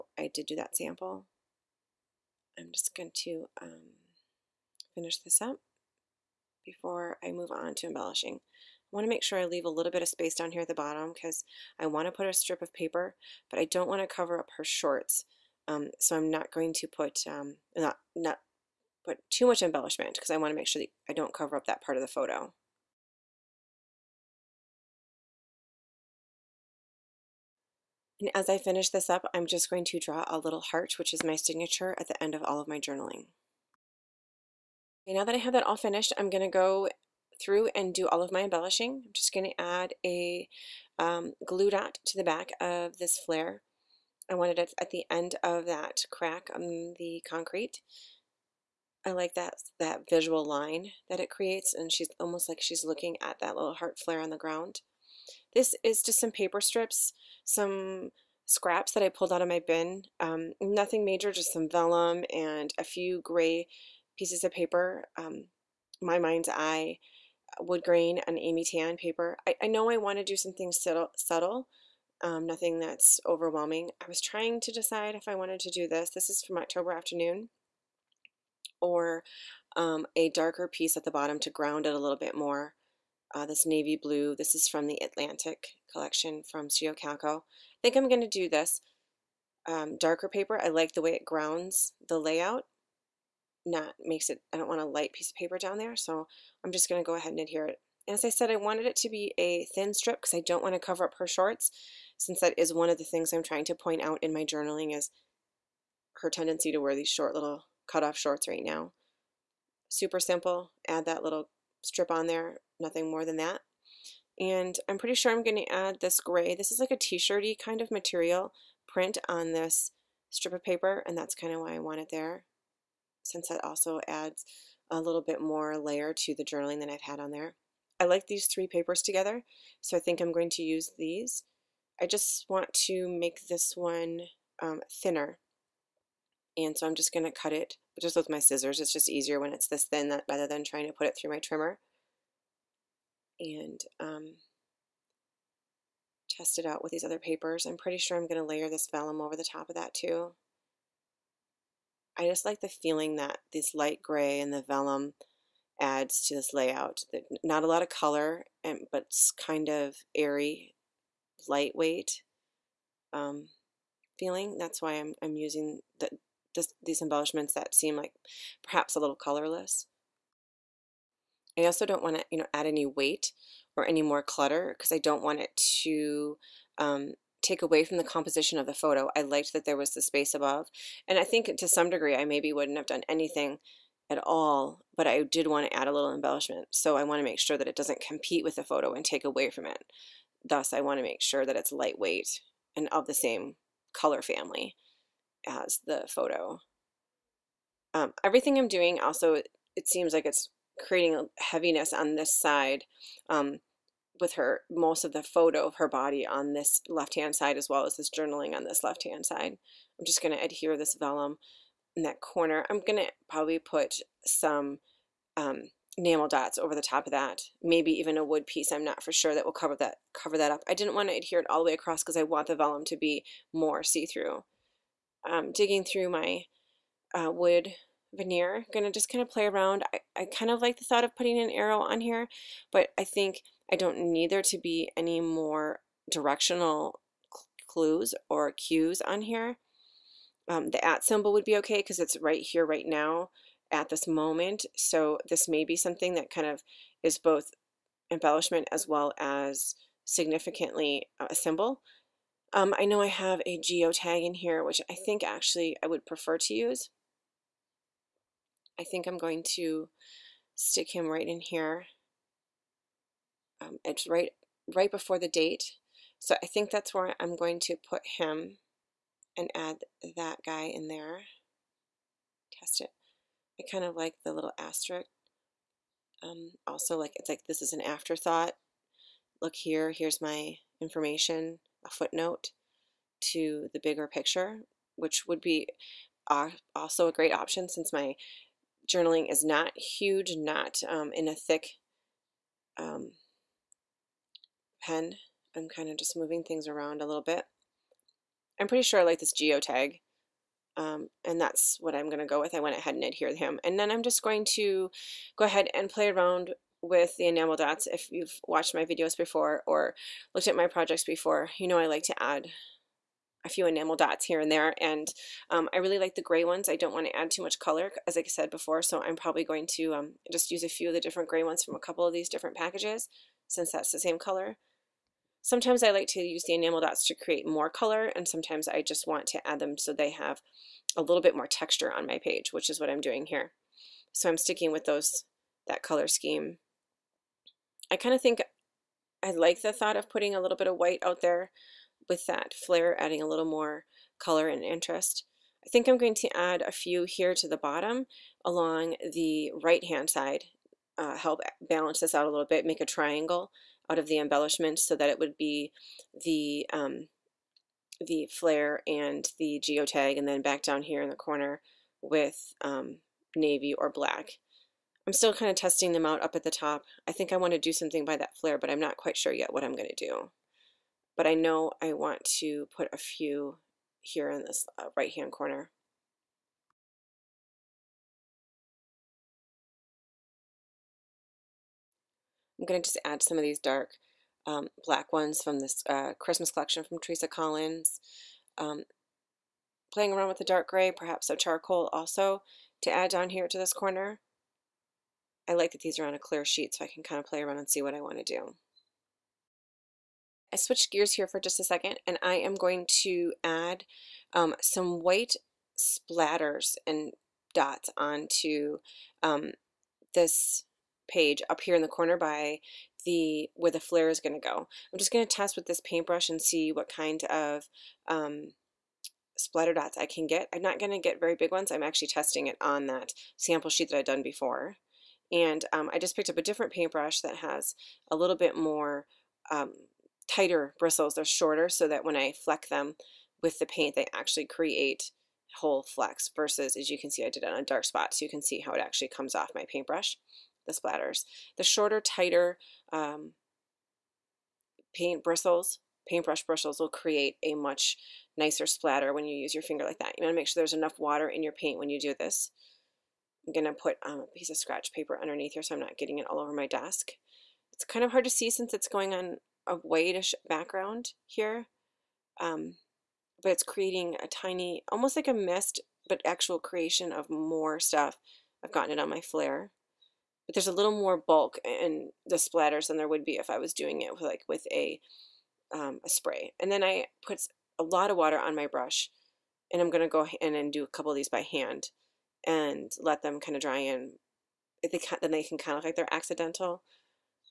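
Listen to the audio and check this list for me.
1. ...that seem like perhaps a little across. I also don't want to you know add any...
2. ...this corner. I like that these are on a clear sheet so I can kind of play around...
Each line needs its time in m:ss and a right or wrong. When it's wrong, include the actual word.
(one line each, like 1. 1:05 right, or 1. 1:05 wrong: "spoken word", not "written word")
1. 2:47 wrong: "colorless", not "across"
2. 6:33 right.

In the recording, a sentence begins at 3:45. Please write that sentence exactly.
Um, digging through my uh, wood veneer.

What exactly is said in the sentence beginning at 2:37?
Not a lot of color, and but it's kind of airy, lightweight um, feeling.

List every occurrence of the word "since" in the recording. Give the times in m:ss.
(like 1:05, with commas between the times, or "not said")
1:42, 2:03, 4:47, 5:23, 7:38.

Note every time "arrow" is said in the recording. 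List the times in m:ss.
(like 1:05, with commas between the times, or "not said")
3:51.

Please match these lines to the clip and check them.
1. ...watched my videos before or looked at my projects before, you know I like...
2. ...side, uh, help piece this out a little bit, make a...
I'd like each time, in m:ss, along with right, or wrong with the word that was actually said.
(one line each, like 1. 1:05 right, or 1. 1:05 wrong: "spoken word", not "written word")
1. 5:08 right
2. 5:50 wrong: "balance", not "piece".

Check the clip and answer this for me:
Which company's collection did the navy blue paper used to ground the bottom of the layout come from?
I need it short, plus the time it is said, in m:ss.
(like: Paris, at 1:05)
Studio Calico, at 1:26.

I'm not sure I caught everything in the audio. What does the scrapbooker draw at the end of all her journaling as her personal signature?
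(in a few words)
A little heart.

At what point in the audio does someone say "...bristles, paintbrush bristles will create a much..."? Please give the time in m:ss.
7:25.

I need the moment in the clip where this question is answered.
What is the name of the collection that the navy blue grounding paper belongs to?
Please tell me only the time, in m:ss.
1:25.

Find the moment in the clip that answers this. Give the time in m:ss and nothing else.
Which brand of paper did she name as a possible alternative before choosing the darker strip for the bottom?
1:16.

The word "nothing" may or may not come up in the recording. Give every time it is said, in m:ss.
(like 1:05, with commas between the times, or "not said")
1:00, 1:12, 1:52.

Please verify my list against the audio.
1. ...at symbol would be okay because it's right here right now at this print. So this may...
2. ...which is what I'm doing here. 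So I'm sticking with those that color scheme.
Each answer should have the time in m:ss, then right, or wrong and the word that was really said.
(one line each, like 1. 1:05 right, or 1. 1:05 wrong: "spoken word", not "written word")
1. 4:00 wrong: "moment", not "print"
2. 5:32 right.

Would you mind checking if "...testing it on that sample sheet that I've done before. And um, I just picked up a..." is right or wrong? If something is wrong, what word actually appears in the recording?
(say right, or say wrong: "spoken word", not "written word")
right.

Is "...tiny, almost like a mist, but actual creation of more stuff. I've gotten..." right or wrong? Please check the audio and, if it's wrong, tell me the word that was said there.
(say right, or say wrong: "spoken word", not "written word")
right.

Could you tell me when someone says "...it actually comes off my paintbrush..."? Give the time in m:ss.
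7:18.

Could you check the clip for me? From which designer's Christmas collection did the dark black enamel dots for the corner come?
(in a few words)
Teresa Collins.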